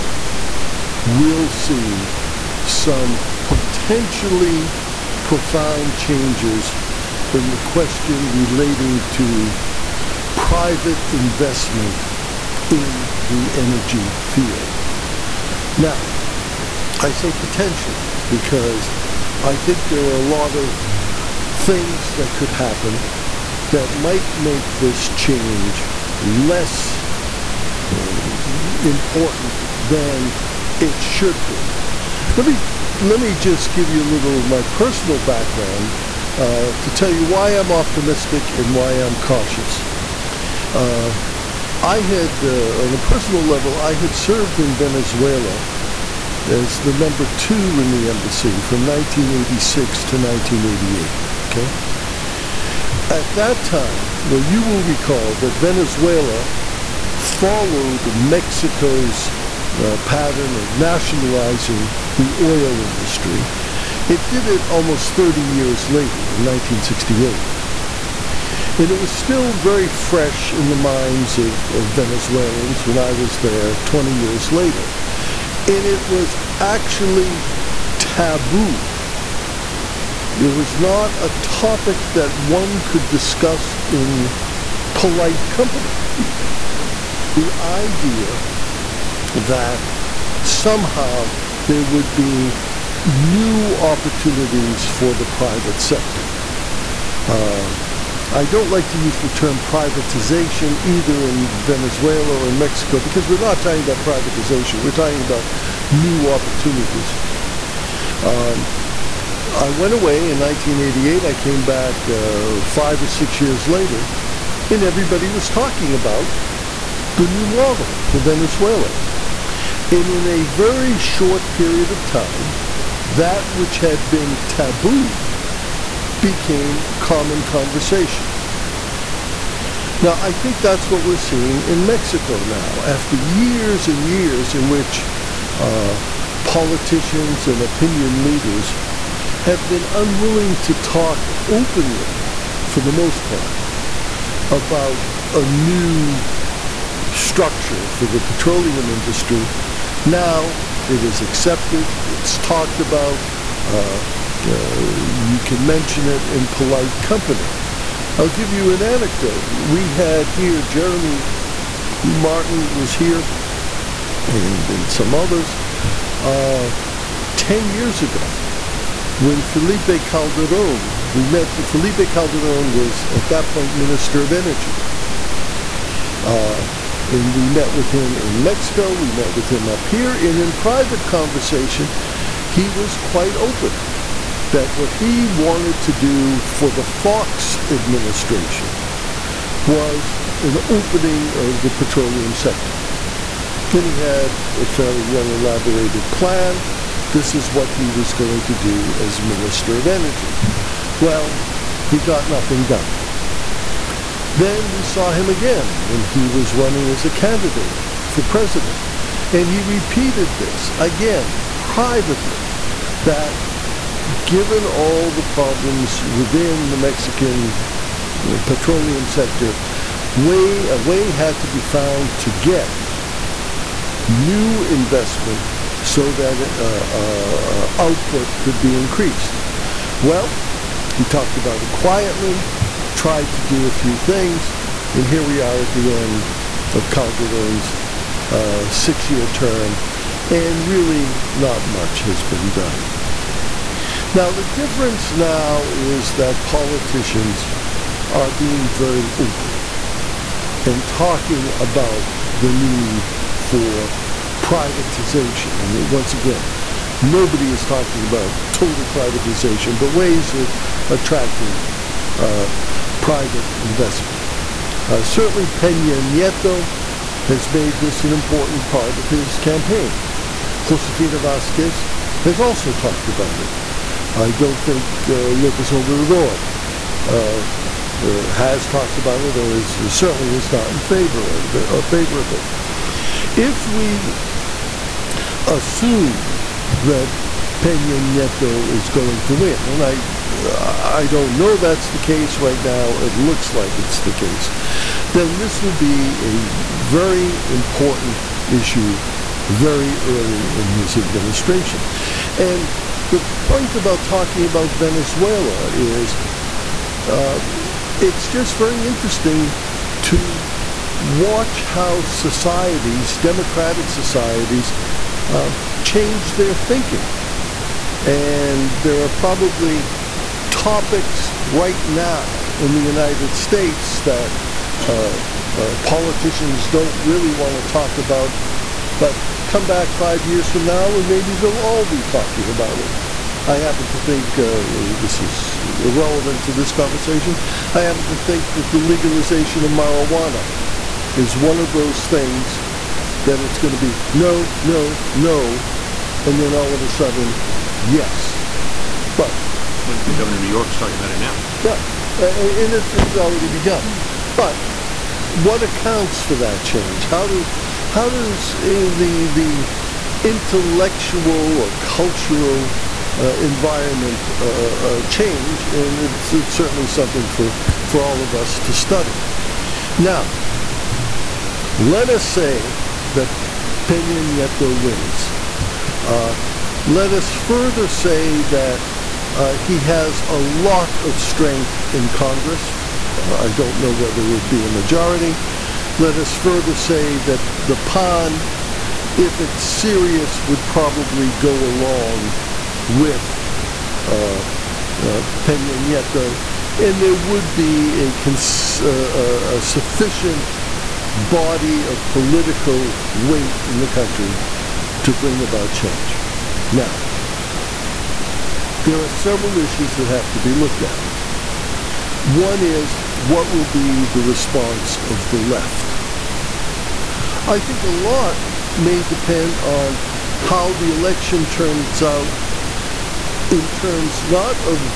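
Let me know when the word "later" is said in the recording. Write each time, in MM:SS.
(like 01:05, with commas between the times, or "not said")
01:05, 01:14, 01:53.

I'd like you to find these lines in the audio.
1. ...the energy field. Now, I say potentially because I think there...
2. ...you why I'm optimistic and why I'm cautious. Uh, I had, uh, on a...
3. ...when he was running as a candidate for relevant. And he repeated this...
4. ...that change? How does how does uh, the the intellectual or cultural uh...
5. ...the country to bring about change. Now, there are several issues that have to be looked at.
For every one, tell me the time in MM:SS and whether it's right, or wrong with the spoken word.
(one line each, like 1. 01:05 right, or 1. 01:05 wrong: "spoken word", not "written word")
1. 00:13 right
2. 00:37 right
3. 03:25 wrong: "president", not "relevant"
4. 05:56 right
5. 06:43 right.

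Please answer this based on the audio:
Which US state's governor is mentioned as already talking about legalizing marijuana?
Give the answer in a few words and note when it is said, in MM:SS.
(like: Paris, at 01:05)
New York, at 05:50.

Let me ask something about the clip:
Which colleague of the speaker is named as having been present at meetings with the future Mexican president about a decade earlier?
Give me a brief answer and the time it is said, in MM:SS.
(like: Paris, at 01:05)
Jeremy Martin, at 02:40.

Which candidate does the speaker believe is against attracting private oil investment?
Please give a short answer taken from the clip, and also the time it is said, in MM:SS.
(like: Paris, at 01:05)
Lopez Obrador, at 04:35.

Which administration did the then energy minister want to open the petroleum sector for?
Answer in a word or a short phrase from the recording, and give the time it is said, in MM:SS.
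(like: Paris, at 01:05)
Fox administration, at 03:06.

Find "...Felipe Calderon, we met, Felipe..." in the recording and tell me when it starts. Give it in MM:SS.
02:49.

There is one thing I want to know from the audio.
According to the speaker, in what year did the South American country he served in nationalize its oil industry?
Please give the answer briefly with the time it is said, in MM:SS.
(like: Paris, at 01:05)
1968, at 01:06.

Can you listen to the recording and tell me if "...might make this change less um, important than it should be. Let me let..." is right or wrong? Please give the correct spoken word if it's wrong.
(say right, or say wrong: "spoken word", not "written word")
right.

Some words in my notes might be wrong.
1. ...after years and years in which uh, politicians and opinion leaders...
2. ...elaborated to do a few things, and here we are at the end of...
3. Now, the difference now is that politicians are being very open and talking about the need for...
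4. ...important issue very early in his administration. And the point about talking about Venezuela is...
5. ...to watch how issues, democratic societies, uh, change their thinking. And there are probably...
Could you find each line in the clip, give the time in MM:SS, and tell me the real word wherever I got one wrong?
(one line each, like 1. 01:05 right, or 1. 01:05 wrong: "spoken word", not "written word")
1. 02:12 right
2. 03:52 wrong: "tried", not "elaborated"
3. 04:04 right
4. 04:57 right
5. 05:10 wrong: "societies", not "issues".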